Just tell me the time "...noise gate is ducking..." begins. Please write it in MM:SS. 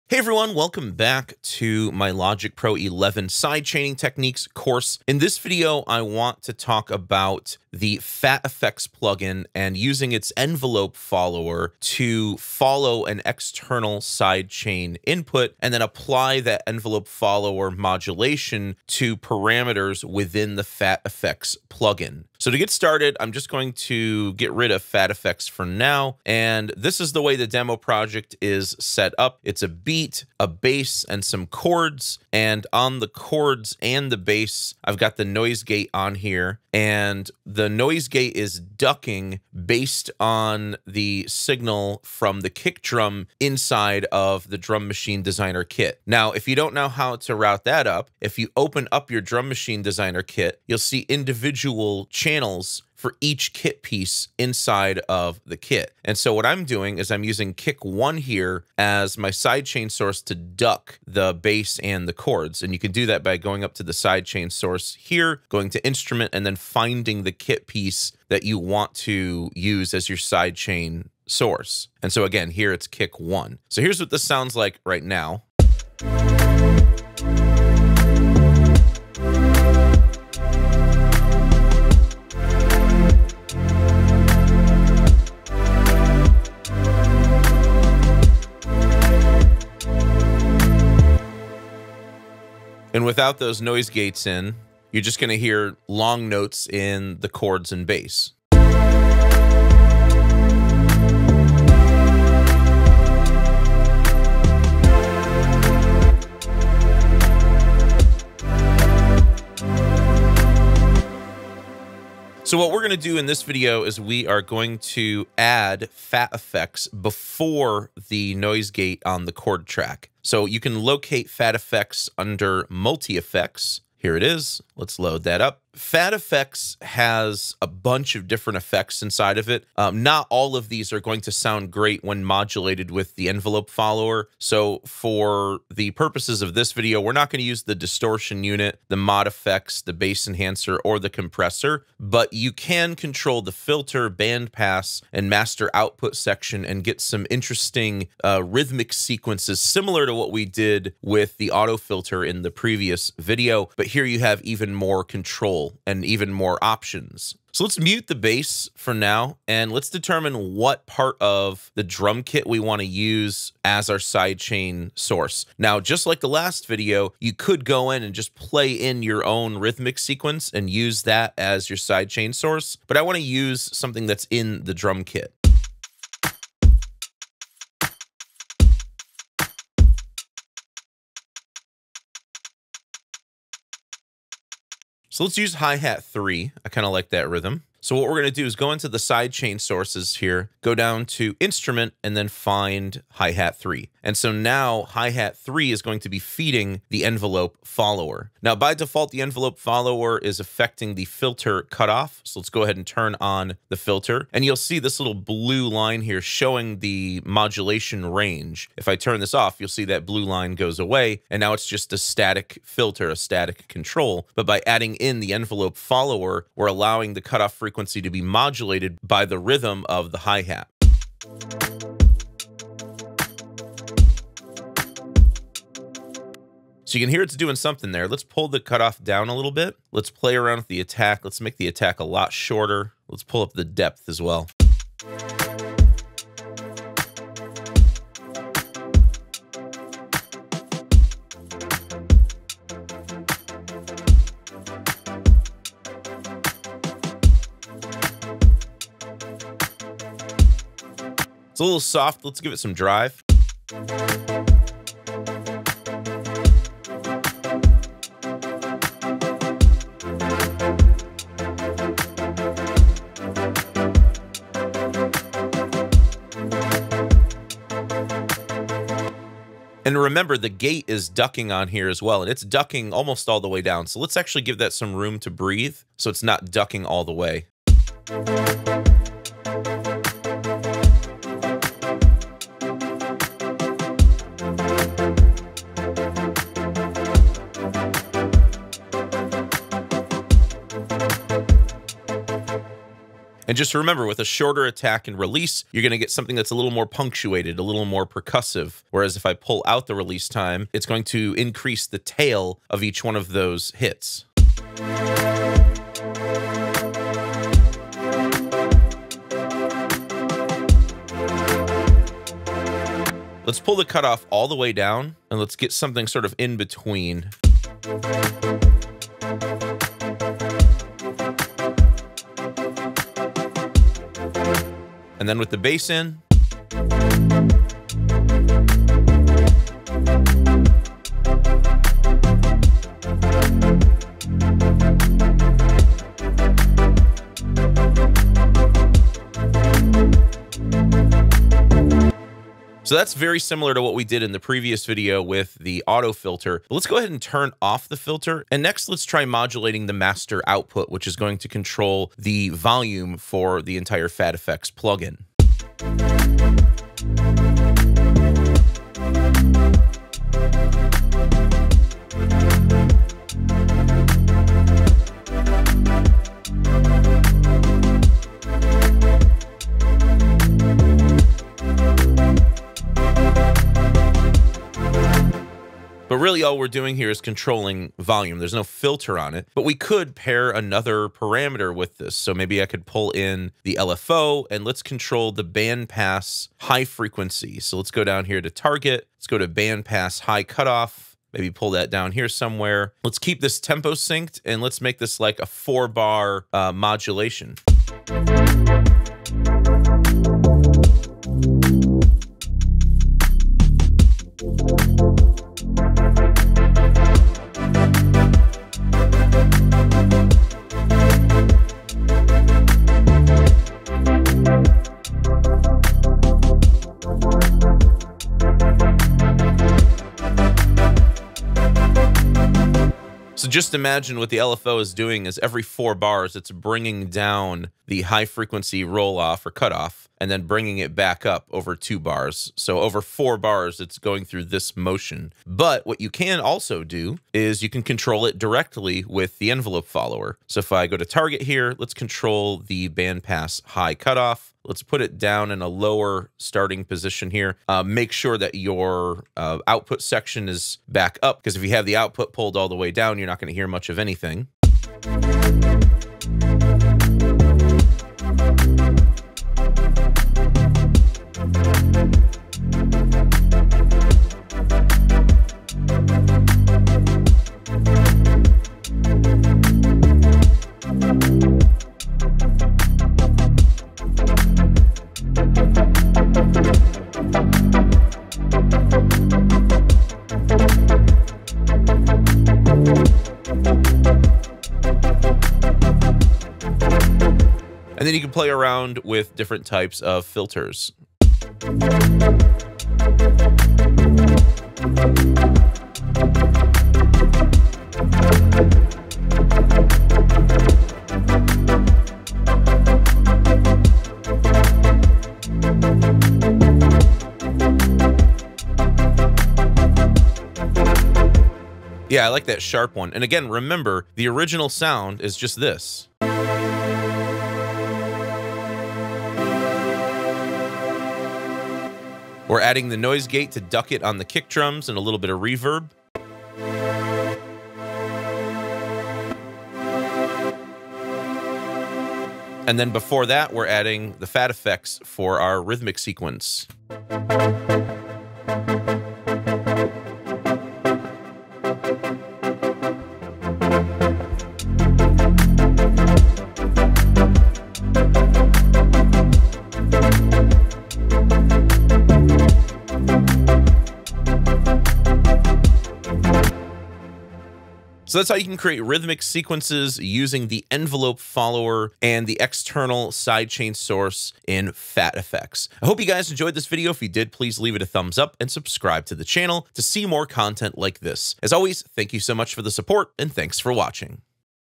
00:37.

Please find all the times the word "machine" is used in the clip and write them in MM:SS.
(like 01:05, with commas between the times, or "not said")
00:44, 00:49.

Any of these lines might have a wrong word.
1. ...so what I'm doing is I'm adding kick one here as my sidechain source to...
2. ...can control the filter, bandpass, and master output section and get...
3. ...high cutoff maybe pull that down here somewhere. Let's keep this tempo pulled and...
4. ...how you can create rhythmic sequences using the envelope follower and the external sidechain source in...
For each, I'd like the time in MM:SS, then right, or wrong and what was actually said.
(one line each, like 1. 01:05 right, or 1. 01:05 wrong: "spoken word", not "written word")
1. 00:56 wrong: "using", not "adding"
2. 02:22 right
3. 06:30 wrong: "synced", not "pulled"
4. 09:18 right.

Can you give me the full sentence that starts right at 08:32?
Yeah, I like that sharp one.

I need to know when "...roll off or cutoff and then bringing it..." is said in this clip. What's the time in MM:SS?
07:08.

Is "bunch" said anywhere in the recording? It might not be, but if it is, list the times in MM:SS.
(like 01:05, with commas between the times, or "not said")
02:07.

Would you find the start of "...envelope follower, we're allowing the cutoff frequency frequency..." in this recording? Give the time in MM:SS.
03:35.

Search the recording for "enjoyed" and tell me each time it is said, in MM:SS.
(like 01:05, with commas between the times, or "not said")
09:26.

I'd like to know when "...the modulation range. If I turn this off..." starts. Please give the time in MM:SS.
03:26.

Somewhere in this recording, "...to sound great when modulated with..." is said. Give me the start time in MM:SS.
02:11.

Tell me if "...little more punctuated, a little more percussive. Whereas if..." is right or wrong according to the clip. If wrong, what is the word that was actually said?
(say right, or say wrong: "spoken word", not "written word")
right.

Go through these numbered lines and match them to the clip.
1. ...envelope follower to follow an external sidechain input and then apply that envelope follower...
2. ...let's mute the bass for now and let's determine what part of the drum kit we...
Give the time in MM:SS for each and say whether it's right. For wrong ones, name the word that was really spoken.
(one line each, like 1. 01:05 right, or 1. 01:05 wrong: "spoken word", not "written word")
1. 00:10 right
2. 02:37 right.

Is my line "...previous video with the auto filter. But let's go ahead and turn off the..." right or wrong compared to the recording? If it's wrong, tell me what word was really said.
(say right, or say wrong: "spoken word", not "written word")
right.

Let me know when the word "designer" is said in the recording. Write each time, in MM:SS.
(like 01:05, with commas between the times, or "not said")
00:45, 00:49.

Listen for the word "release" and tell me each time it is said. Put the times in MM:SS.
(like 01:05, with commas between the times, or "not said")
04:55, 04:59.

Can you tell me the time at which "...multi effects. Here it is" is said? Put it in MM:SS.
02:02.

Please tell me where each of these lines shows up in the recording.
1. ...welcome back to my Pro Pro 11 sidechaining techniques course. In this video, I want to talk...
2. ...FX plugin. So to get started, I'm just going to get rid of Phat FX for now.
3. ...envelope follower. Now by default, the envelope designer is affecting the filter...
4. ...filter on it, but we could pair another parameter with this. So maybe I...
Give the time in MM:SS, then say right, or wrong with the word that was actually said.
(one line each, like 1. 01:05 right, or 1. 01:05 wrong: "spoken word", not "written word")
1. 00:00 wrong: "Logic", not "Pro"
2. 00:21 right
3. 03:17 wrong: "follower", not "designer"
4. 06:18 right.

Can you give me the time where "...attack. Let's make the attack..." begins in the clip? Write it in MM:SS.
03:50.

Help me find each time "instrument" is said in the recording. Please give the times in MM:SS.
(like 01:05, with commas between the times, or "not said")
01:05, 03:11.